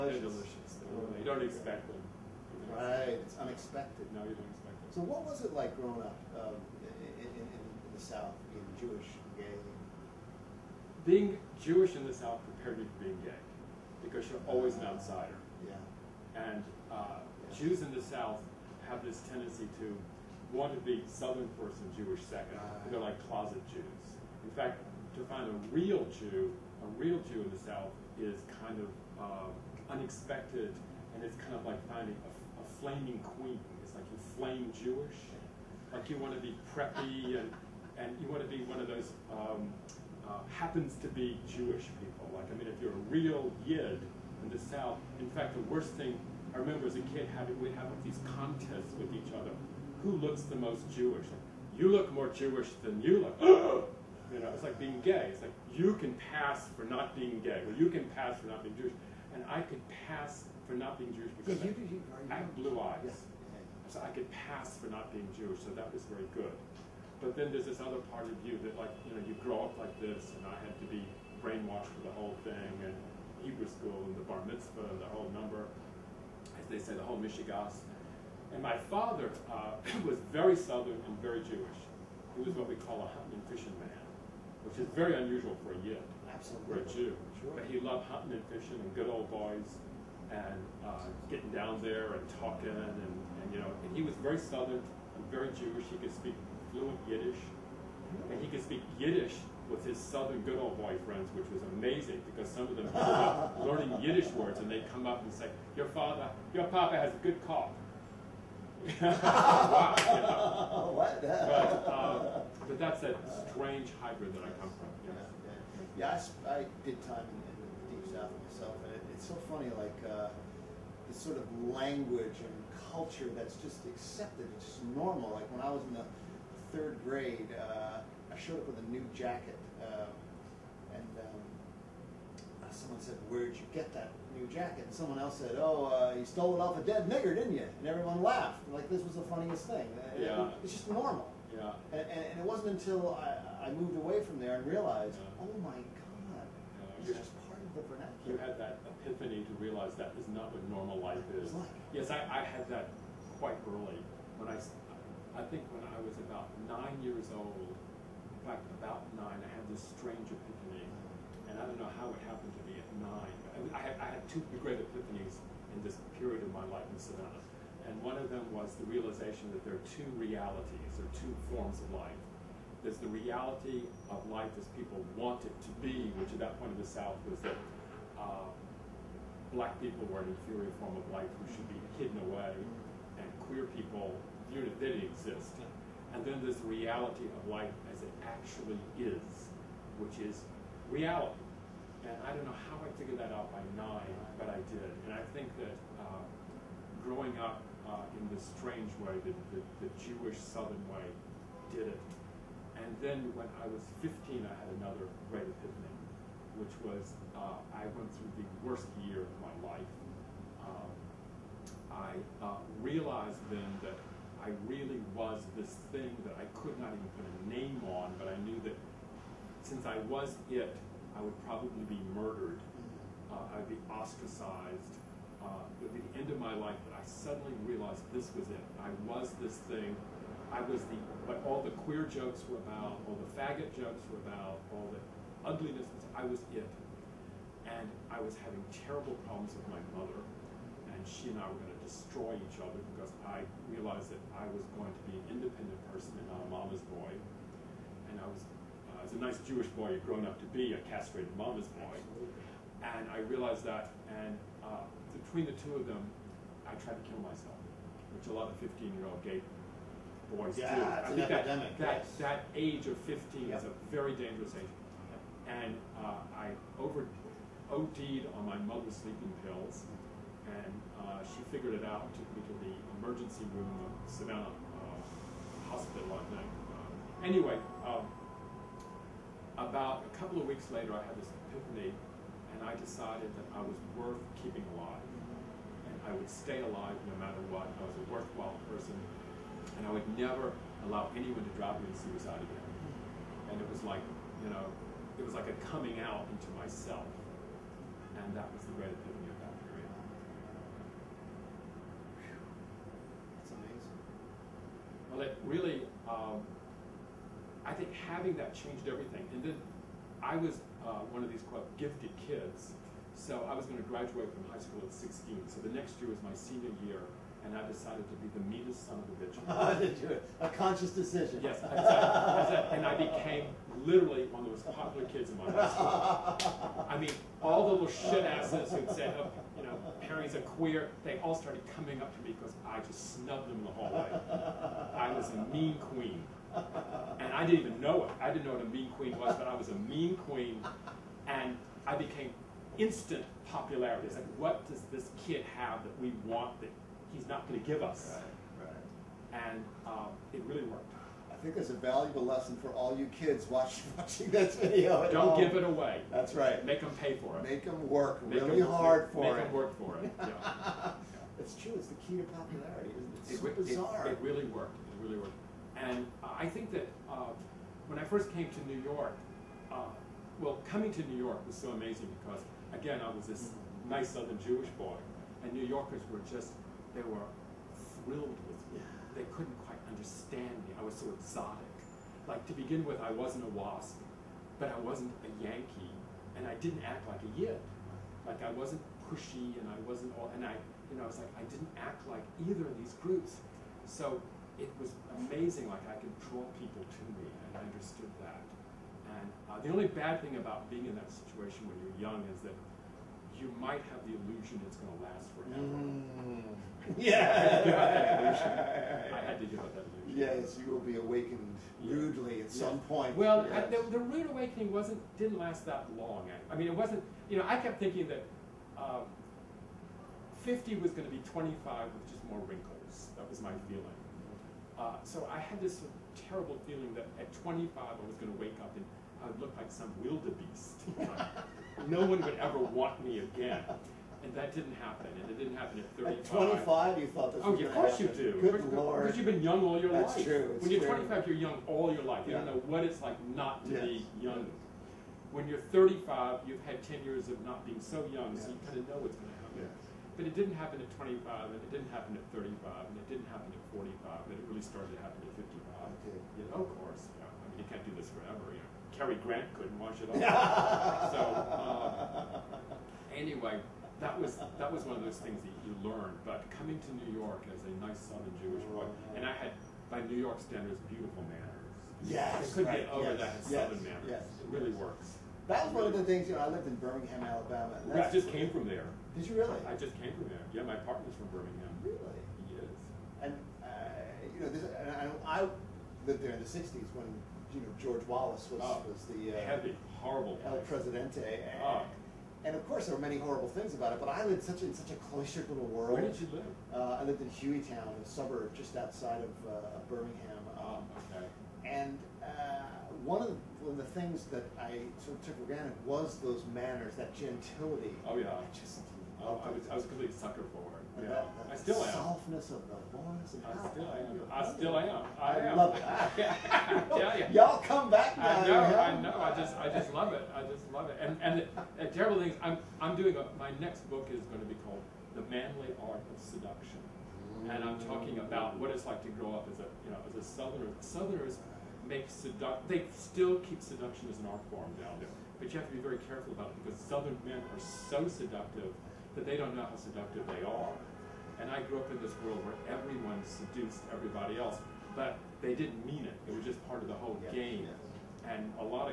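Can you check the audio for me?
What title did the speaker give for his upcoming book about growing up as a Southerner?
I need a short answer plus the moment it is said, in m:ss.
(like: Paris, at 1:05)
The Manly Art of Seduction, at 8:45.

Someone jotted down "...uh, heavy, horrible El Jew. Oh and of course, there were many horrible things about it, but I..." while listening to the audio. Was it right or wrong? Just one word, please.
wrong.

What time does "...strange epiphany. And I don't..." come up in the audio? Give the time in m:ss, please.
2:39.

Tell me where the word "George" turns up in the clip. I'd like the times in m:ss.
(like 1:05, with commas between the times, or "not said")
8:07.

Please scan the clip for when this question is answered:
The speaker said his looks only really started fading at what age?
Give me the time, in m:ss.
7:35.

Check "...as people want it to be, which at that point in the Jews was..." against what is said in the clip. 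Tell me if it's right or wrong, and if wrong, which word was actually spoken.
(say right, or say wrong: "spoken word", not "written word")
wrong: "South", not "Jews".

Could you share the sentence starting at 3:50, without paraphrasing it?
I was the, what all the queer jokes were about, all the faggot jokes were about, all the ugliness, I was it.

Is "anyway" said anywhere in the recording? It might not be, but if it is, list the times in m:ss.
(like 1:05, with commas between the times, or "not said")
4:37, 7:43.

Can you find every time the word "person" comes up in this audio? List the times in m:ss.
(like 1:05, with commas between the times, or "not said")
4:05, 4:48.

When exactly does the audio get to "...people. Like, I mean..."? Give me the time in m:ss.
0:41.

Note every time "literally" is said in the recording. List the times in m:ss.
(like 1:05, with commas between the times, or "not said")
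5:23.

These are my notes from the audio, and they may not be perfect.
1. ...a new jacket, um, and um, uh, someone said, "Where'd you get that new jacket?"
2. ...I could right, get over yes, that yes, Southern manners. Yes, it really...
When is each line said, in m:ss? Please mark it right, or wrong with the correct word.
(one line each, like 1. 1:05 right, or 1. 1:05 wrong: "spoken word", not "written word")
1. 2:08 right
2. 7:52 right.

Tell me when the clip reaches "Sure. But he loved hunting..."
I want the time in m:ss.
1:27.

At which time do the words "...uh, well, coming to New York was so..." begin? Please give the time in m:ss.
6:09.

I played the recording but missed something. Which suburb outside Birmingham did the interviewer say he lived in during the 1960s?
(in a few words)
Hueytown.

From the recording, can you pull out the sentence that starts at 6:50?
Yes, you will be awakened rudely at some point.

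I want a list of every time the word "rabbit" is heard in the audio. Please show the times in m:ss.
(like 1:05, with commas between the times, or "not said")
not said.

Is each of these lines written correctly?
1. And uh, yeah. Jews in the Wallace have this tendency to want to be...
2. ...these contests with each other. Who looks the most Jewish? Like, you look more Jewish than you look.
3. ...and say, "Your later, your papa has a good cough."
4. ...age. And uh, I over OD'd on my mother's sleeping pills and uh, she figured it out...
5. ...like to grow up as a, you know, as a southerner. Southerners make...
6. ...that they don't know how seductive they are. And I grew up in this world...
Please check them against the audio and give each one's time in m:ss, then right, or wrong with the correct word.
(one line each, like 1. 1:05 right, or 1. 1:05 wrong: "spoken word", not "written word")
1. 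0:16 wrong: "South", not "Wallace"
2. 0:48 right
3. 1:45 wrong: "father", not "later"
4. 4:24 right
5. 8:48 right
6. 8:59 right.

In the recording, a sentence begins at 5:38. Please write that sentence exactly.
I didn't know what a mean queen was, but I was a mean queen.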